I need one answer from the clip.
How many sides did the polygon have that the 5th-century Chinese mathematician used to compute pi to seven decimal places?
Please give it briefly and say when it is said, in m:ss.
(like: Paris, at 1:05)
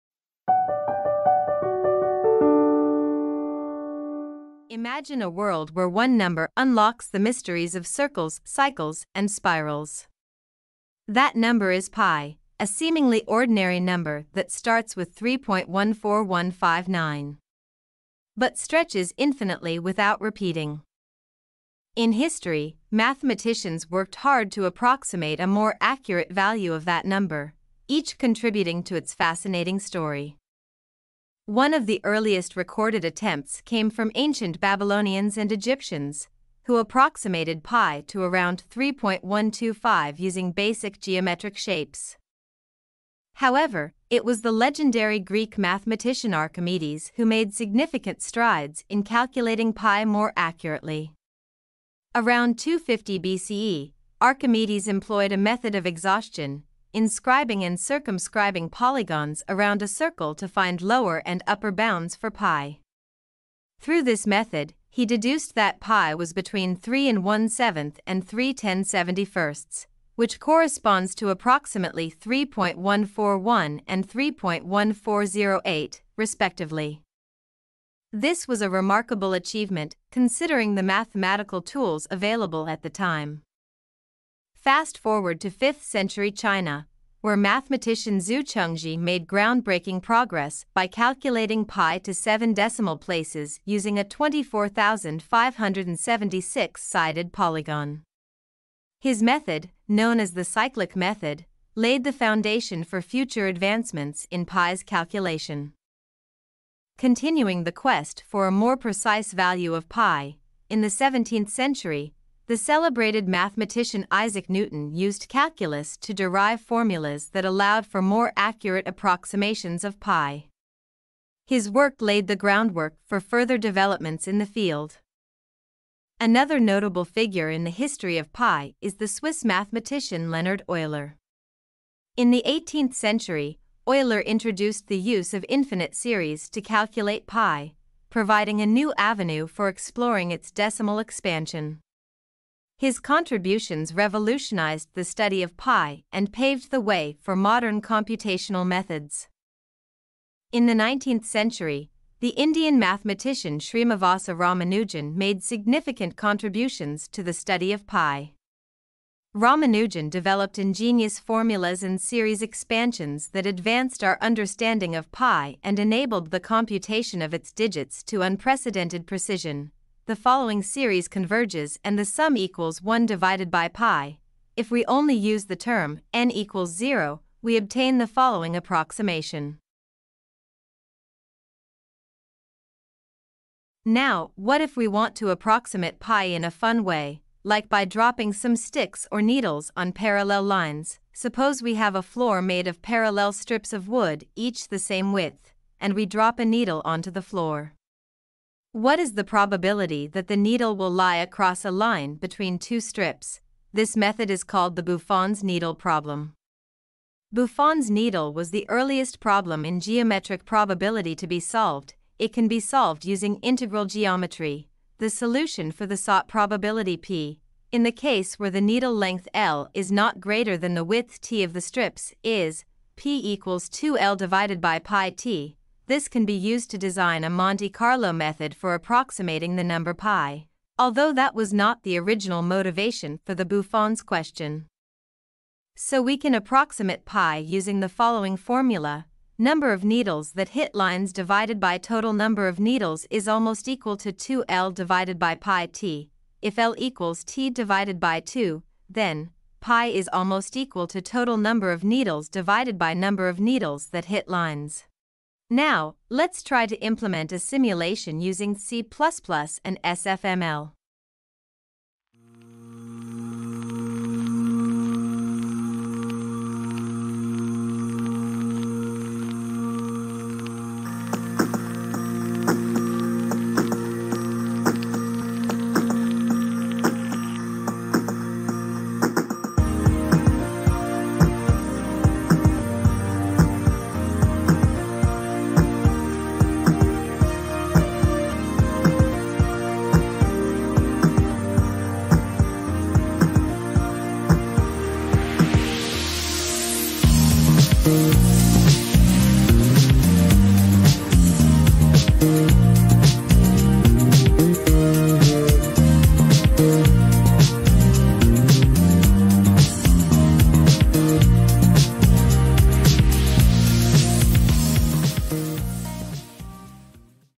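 24,576, at 1:34.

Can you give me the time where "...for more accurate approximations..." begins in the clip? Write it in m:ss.
1:57.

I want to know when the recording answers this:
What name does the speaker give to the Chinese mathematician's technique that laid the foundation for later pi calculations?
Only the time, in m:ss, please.
1:40.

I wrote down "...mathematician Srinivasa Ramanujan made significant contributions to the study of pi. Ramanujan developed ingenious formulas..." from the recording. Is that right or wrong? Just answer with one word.
right.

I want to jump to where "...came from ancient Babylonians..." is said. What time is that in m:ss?
0:33.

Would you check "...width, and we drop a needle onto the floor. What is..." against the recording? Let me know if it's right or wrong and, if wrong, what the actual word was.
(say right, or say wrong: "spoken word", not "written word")
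right.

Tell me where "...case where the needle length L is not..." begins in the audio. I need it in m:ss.
3:37.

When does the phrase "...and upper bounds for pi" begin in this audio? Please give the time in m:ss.
1:01.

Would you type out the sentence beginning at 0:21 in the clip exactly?
In history, mathematicians worked hard to approximate a more accurate value of that number, each contributing to its fascinating story.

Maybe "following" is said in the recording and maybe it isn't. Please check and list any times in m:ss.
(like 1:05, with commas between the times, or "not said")
2:50, 2:58, 3:57.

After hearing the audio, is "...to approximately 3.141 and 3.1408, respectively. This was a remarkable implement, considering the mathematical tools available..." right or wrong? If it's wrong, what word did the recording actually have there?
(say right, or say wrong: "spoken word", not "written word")
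wrong: "achievement", not "implement".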